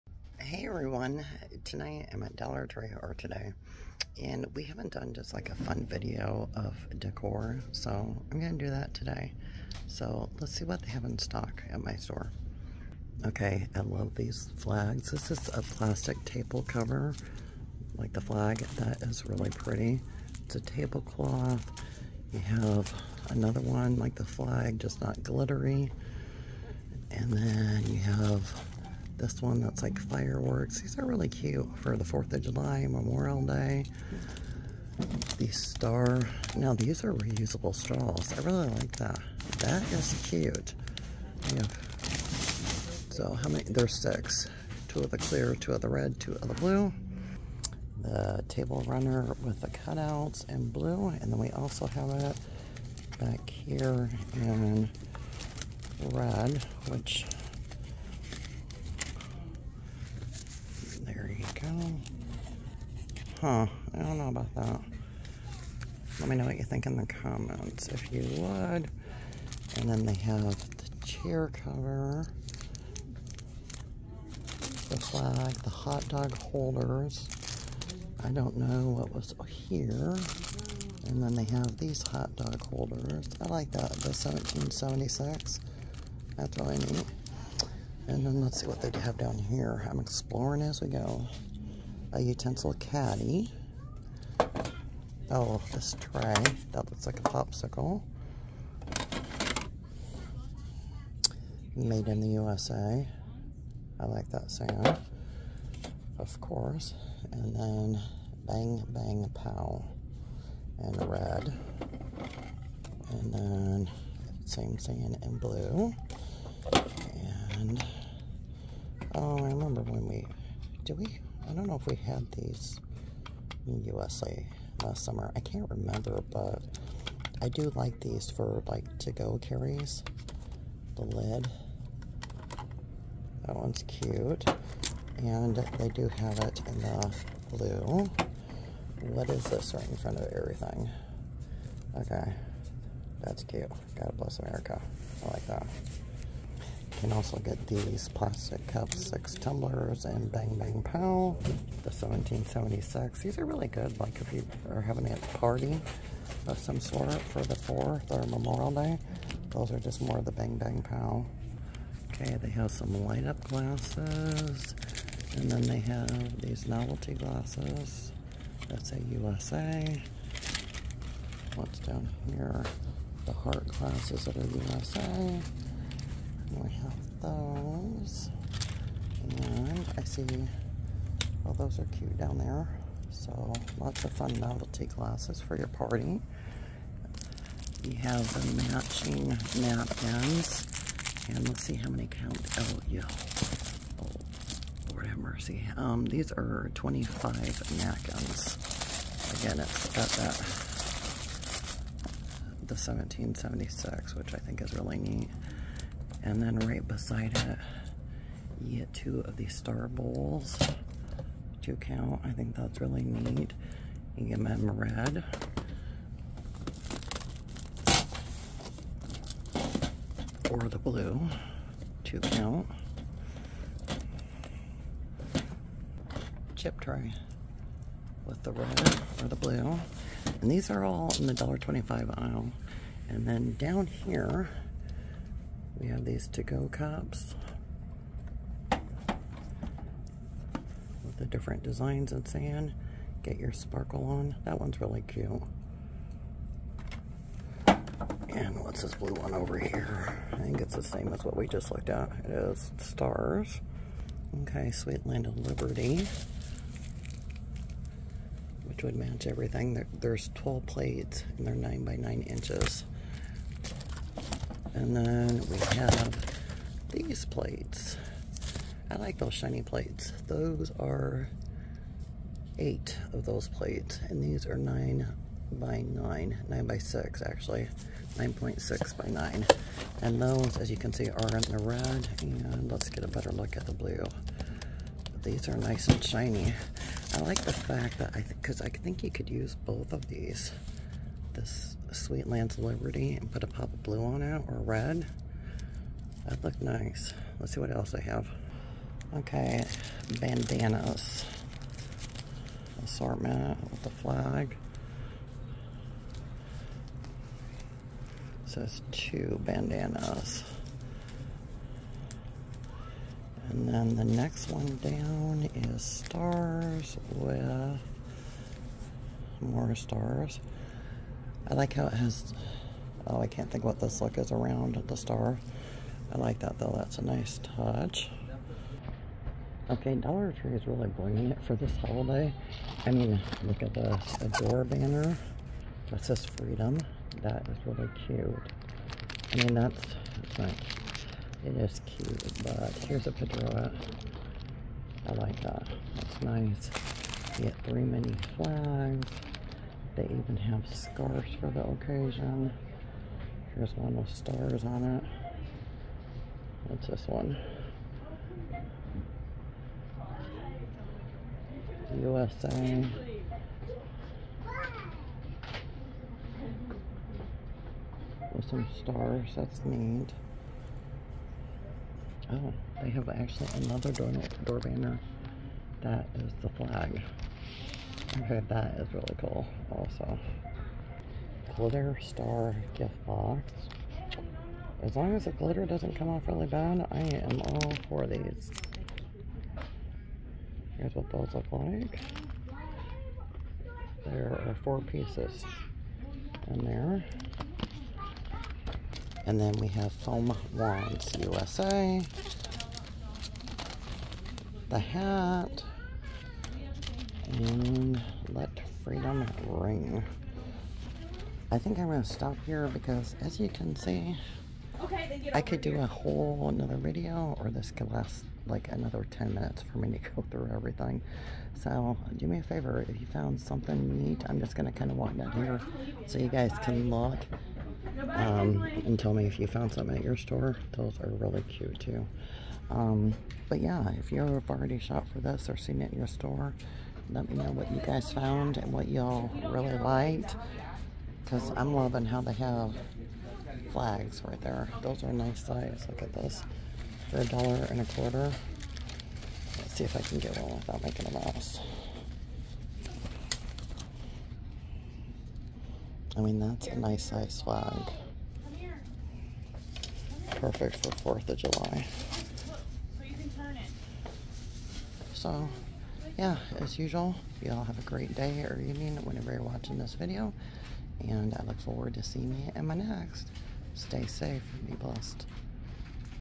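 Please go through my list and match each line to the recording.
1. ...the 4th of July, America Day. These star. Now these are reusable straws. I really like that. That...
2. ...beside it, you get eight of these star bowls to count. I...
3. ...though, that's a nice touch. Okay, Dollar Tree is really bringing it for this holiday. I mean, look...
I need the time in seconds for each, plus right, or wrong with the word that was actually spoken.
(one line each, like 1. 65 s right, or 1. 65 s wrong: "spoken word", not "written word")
1. 31 s wrong: "Memorial", not "America"
2. 206 s wrong: "two", not "eight"
3. 326 s right.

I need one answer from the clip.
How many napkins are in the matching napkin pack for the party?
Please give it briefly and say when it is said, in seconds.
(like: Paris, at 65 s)
25, at 196 s.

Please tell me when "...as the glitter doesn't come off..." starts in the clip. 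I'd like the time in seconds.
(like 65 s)
385 s.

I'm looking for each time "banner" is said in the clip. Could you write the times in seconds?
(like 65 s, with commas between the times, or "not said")
334 s, 374 s.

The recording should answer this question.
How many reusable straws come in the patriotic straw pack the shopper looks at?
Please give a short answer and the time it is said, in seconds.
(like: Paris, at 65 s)
6, at 43 s.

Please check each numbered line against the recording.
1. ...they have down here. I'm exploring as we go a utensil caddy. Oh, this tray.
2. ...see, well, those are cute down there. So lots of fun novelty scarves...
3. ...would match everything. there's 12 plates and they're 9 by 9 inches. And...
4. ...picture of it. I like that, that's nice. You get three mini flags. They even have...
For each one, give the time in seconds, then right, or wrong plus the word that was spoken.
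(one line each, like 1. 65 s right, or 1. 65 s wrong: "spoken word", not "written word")
1. 88 s right
2. 180 s wrong: "glasses", not "scarves"
3. 258 s right
4. 343 s right.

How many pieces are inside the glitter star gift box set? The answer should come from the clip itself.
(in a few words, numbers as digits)
4.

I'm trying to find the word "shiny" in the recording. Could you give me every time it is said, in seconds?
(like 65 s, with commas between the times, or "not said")
269 s, 286 s.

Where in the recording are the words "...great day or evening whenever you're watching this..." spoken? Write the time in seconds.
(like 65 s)
467 s.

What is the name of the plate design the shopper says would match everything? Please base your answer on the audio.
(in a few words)
Sweet Land of Liberty.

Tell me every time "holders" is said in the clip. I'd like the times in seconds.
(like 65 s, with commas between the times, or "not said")
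76 s, 82 s.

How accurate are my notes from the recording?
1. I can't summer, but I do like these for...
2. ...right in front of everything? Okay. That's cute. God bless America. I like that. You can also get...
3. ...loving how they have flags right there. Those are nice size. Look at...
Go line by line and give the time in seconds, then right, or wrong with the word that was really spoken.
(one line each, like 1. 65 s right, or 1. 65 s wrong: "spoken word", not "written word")
1. 125 s wrong: "remember", not "summer"
2. 139 s right
3. 441 s right.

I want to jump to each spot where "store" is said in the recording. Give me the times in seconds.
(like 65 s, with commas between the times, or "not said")
11 s, 430 s, 436 s.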